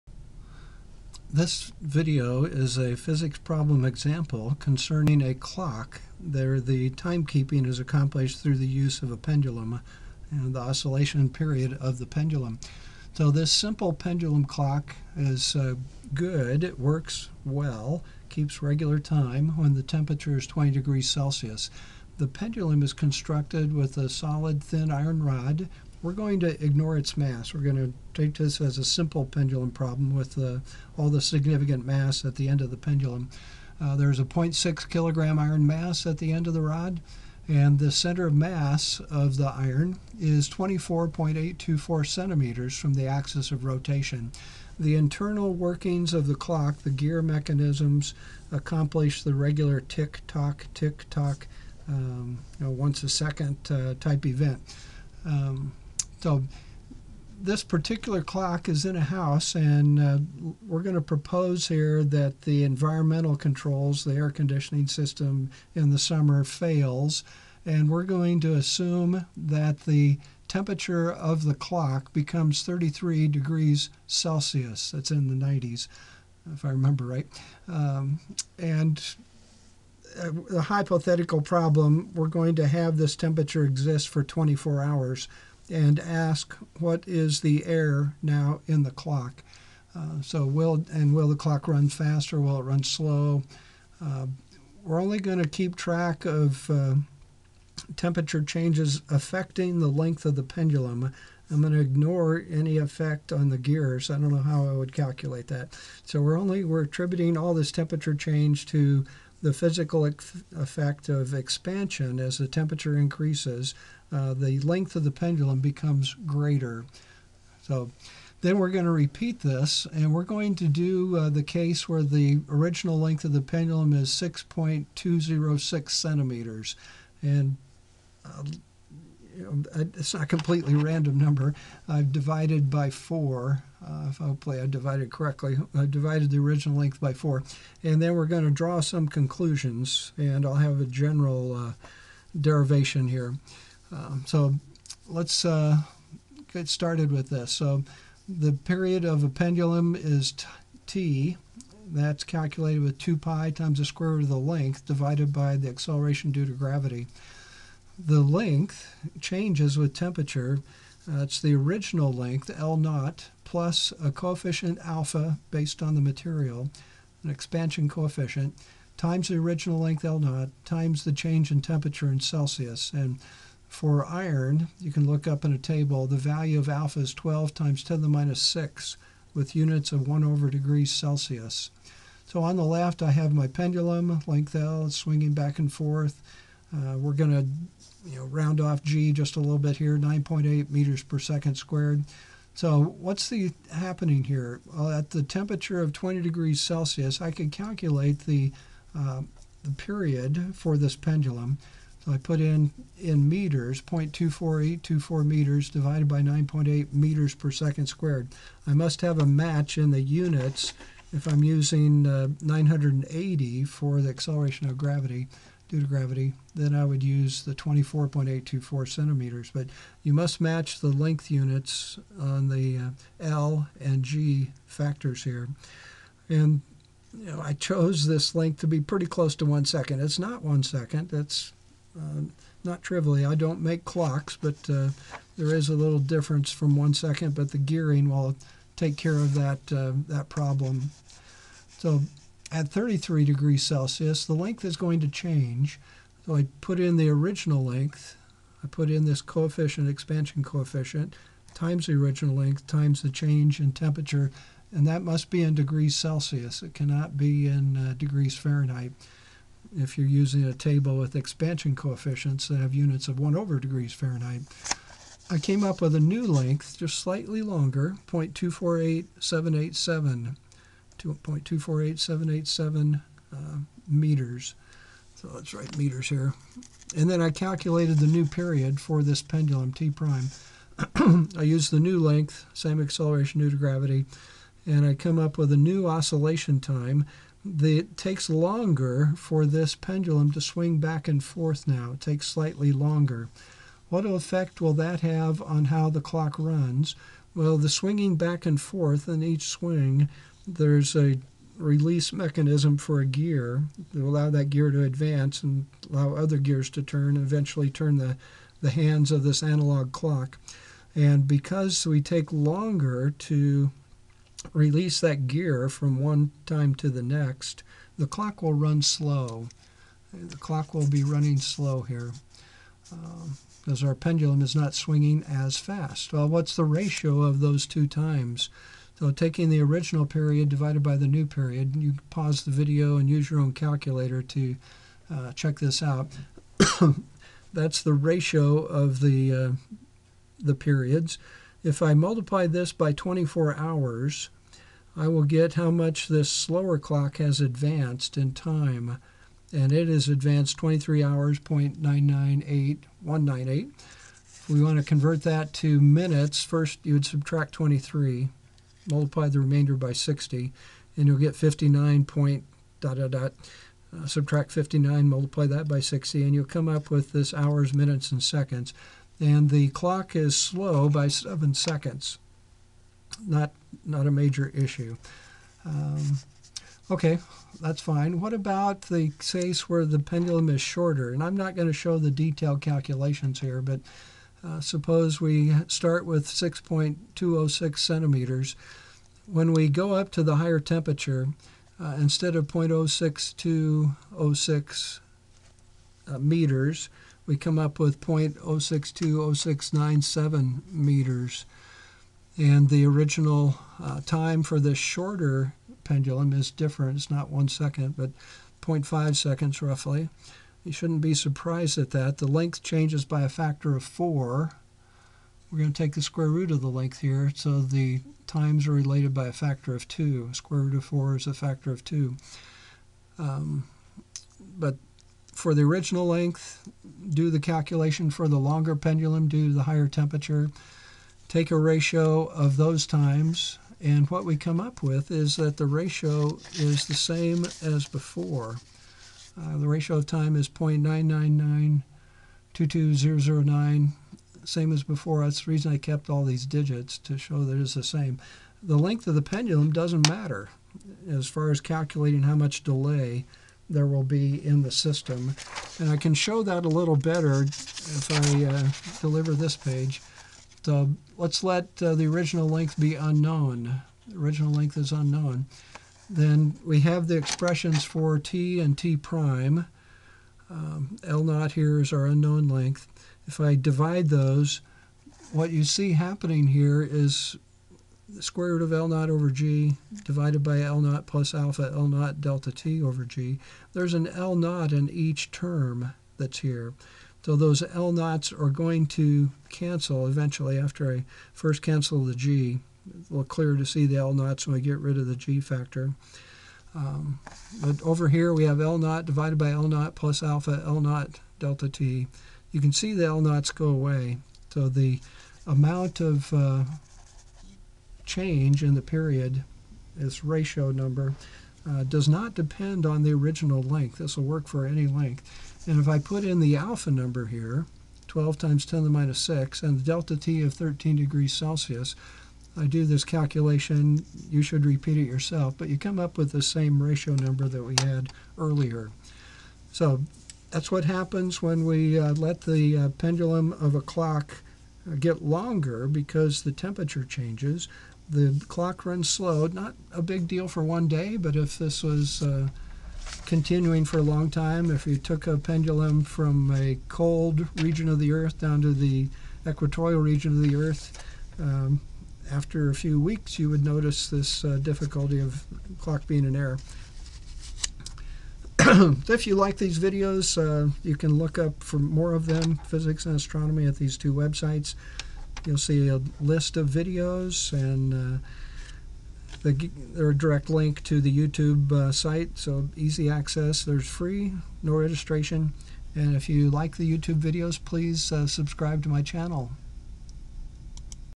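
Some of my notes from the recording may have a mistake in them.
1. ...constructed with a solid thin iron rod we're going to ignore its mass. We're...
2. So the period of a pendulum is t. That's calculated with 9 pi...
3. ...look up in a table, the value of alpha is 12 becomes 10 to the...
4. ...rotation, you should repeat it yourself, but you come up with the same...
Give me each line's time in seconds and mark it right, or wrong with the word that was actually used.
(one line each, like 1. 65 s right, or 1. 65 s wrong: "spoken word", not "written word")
1. 22 s right
2. 147 s wrong: "2", not "9"
3. 175 s wrong: "times", not "becomes"
4. 523 s wrong: "calculation", not "rotation".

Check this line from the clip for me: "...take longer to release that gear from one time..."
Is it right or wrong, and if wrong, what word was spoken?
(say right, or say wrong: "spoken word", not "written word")
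right.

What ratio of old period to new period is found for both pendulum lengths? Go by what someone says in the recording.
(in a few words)
0.99922009.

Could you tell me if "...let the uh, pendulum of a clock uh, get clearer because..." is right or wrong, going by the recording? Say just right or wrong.
wrong.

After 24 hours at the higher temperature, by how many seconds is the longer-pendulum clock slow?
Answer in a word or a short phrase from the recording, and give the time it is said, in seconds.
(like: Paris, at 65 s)
7 seconds, at 371 s.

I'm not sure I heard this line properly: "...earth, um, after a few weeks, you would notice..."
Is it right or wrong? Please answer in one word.
right.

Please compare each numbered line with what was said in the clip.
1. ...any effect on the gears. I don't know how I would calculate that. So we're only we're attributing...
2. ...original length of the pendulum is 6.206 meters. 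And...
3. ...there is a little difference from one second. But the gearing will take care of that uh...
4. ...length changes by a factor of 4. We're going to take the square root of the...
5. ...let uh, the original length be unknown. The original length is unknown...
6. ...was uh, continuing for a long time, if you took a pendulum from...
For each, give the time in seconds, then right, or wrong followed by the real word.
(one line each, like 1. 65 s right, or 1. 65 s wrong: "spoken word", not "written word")
1. 102 s right
2. 122 s wrong: "centimeters", not "meters"
3. 235 s right
4. 412 s right
5. 461 s right
6. 541 s right.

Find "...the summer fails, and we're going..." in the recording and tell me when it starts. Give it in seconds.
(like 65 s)
65 s.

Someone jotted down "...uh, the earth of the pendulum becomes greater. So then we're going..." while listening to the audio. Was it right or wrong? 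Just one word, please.
wrong.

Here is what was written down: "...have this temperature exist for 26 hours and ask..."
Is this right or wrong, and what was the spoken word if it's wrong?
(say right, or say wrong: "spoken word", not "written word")
wrong: "24", not "26".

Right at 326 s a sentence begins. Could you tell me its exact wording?
Well, what's the ratio of those two times?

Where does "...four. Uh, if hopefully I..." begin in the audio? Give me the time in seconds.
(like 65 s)
132 s.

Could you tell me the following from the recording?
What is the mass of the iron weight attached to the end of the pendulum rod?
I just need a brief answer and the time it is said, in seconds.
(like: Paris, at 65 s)
0.6 kg, at 34 s.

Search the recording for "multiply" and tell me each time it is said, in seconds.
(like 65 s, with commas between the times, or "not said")
341 s, 358 s, 365 s.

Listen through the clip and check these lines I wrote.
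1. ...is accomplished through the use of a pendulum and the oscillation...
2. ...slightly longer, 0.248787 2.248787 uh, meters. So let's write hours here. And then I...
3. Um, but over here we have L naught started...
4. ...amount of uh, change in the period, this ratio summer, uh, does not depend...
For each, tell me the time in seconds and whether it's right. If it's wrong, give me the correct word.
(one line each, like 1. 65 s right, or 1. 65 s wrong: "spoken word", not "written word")
1. 7 s right
2. 266 s wrong: "meters", not "hours"
3. 496 s wrong: "divided", not "started"
4. 505 s wrong: "number", not "summer".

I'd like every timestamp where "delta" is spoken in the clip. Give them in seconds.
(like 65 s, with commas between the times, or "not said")
482 s, 501 s, 519 s.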